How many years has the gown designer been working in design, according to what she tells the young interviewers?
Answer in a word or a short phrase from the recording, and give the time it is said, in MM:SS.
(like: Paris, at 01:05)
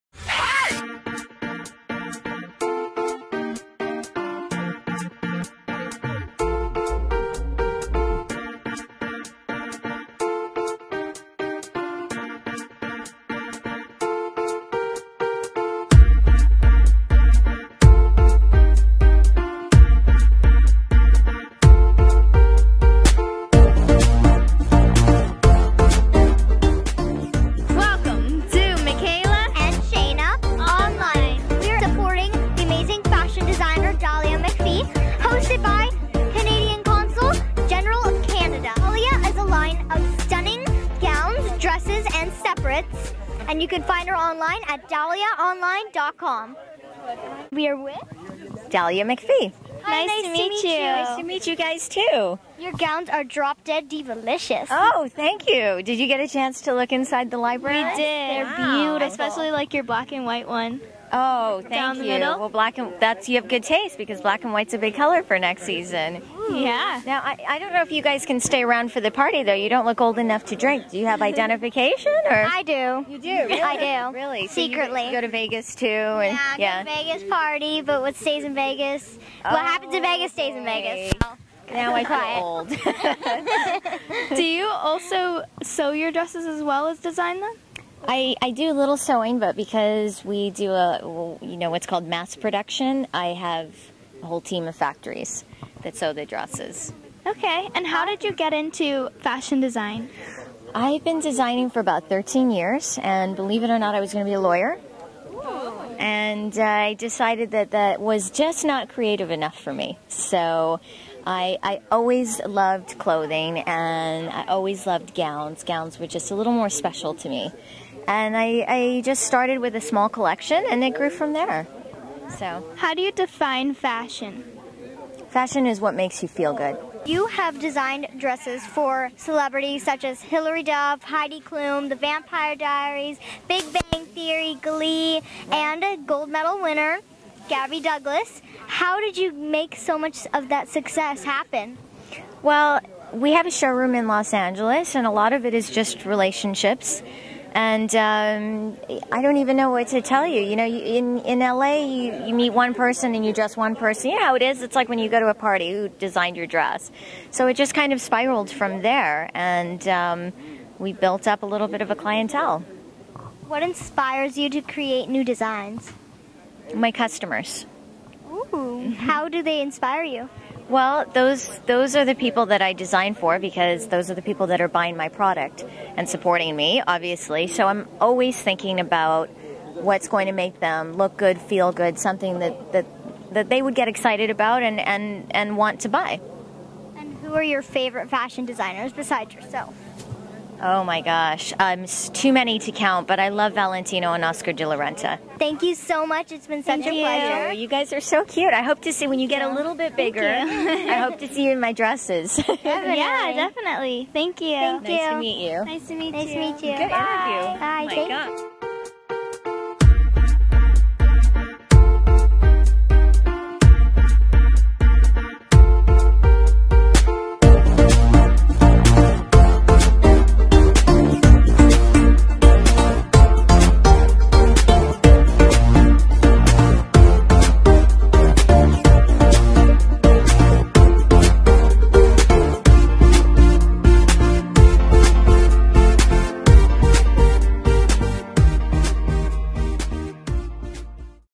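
13, at 01:42.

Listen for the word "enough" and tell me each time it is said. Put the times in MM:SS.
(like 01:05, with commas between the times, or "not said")
01:10, 01:49.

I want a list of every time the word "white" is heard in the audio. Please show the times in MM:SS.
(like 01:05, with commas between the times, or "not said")
01:00, 01:04.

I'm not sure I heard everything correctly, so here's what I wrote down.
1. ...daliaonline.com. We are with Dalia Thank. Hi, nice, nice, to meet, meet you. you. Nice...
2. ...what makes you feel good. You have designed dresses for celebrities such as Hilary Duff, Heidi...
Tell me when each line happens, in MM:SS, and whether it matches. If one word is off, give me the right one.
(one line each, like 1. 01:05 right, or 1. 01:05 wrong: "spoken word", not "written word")
1. 00:44 wrong: "MacPhee", not "Thank"
2. 02:05 right.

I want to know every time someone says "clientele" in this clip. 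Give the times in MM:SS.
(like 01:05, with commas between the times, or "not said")
02:41.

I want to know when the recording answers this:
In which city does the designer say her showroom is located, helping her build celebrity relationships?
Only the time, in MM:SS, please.
02:24.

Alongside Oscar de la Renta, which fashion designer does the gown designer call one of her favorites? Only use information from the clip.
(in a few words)
Valentino.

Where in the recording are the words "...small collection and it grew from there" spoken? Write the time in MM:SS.
01:59.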